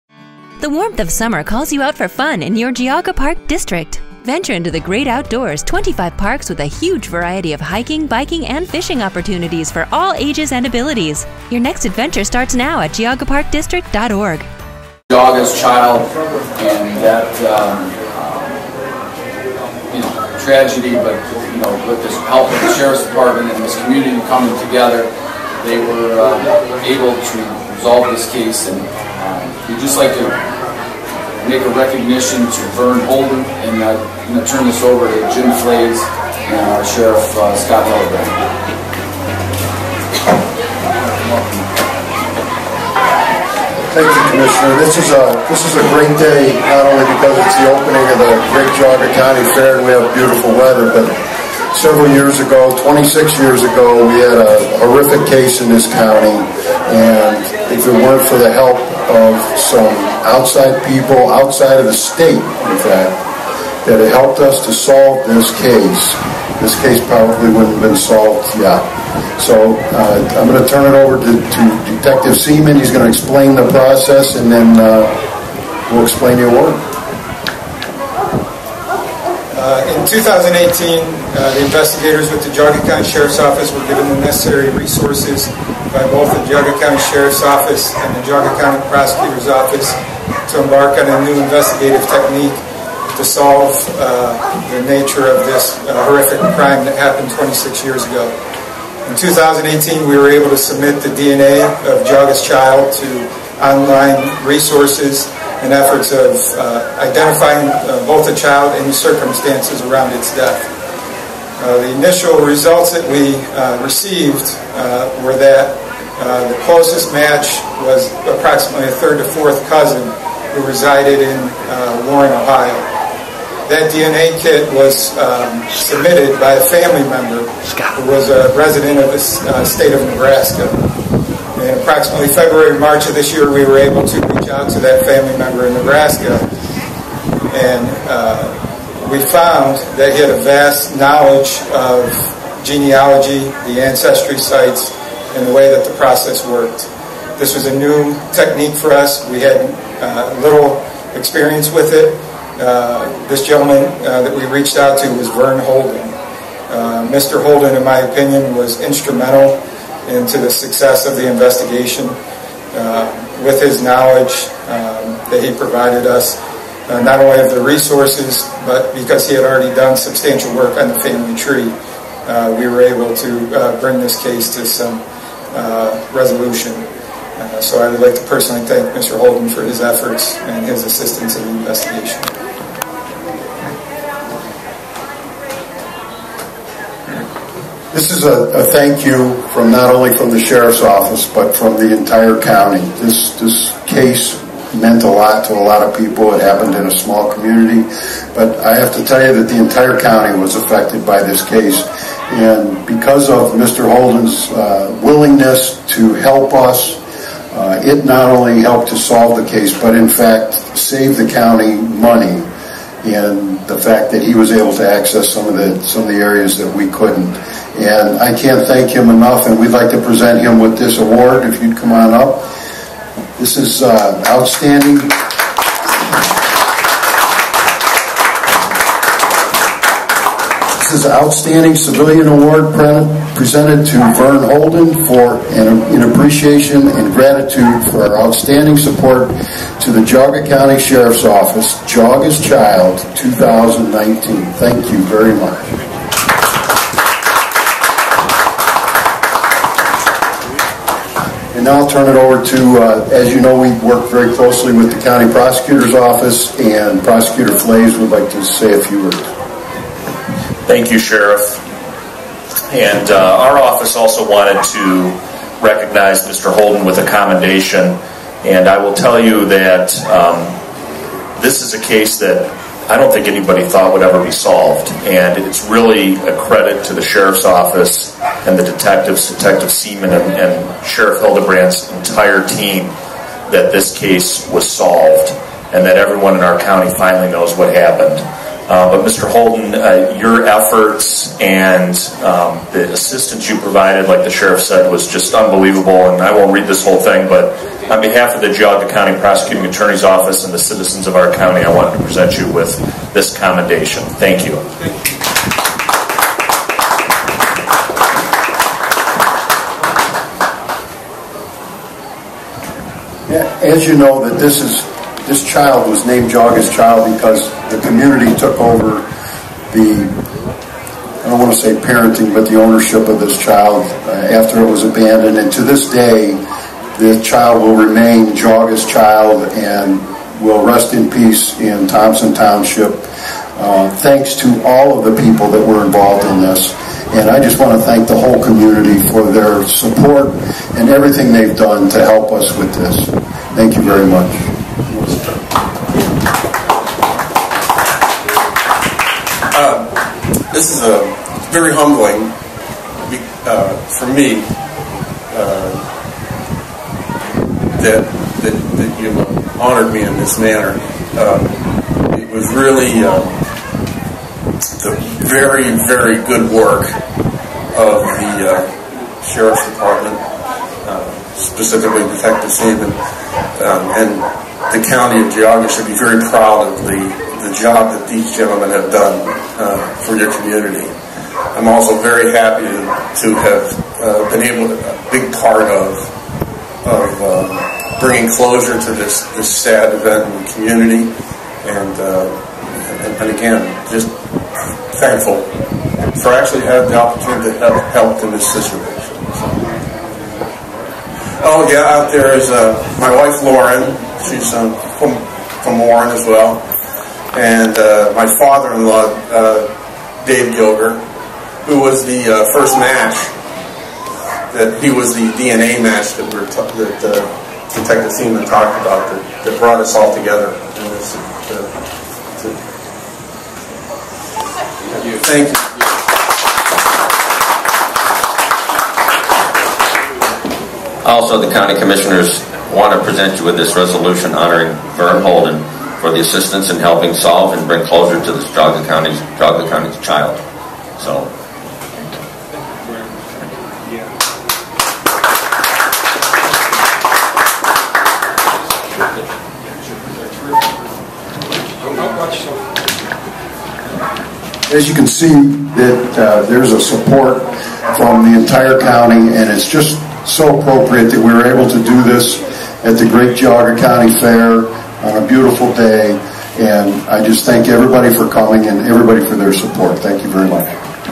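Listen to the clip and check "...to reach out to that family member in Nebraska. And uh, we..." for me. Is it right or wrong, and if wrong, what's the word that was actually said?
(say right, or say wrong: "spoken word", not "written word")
right.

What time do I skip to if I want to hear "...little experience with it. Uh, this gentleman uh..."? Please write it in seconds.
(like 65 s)
150 s.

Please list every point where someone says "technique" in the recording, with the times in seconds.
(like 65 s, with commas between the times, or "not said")
92 s, 148 s.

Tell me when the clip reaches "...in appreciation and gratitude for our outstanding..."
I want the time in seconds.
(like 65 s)
235 s.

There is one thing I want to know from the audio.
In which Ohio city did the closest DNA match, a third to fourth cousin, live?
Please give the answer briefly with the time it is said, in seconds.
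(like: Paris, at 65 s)
Warren, Ohio, at 122 s.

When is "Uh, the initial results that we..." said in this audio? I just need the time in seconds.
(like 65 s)
111 s.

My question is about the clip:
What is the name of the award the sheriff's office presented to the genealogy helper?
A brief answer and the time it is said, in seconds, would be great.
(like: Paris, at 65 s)
Outstanding civilian award, at 231 s.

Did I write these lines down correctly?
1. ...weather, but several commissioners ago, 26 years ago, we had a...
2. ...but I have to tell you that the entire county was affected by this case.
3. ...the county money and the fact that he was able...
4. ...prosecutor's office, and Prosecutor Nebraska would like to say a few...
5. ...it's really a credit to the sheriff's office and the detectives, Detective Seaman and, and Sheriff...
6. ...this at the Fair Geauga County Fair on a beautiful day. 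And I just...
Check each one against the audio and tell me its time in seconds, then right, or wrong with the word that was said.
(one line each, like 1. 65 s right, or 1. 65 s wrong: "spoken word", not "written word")
1. 50 s wrong: "years", not "commissioners"
2. 198 s right
3. 211 s right
4. 255 s wrong: "Flaiz", not "Nebraska"
5. 275 s right
6. 462 s wrong: "Great", not "Fair".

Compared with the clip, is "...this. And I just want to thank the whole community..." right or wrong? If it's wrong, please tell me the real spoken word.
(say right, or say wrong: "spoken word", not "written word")
right.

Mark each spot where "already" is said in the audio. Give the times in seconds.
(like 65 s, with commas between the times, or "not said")
169 s.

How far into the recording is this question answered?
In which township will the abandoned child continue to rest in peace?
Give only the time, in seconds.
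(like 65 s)
331 s.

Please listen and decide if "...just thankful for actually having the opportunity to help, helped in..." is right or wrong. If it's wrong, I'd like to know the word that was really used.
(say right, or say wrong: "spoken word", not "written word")
right.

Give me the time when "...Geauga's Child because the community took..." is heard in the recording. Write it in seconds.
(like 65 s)
316 s.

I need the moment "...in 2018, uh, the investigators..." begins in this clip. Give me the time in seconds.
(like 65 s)
79 s.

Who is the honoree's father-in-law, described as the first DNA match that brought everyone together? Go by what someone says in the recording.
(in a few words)
Dave Gilger.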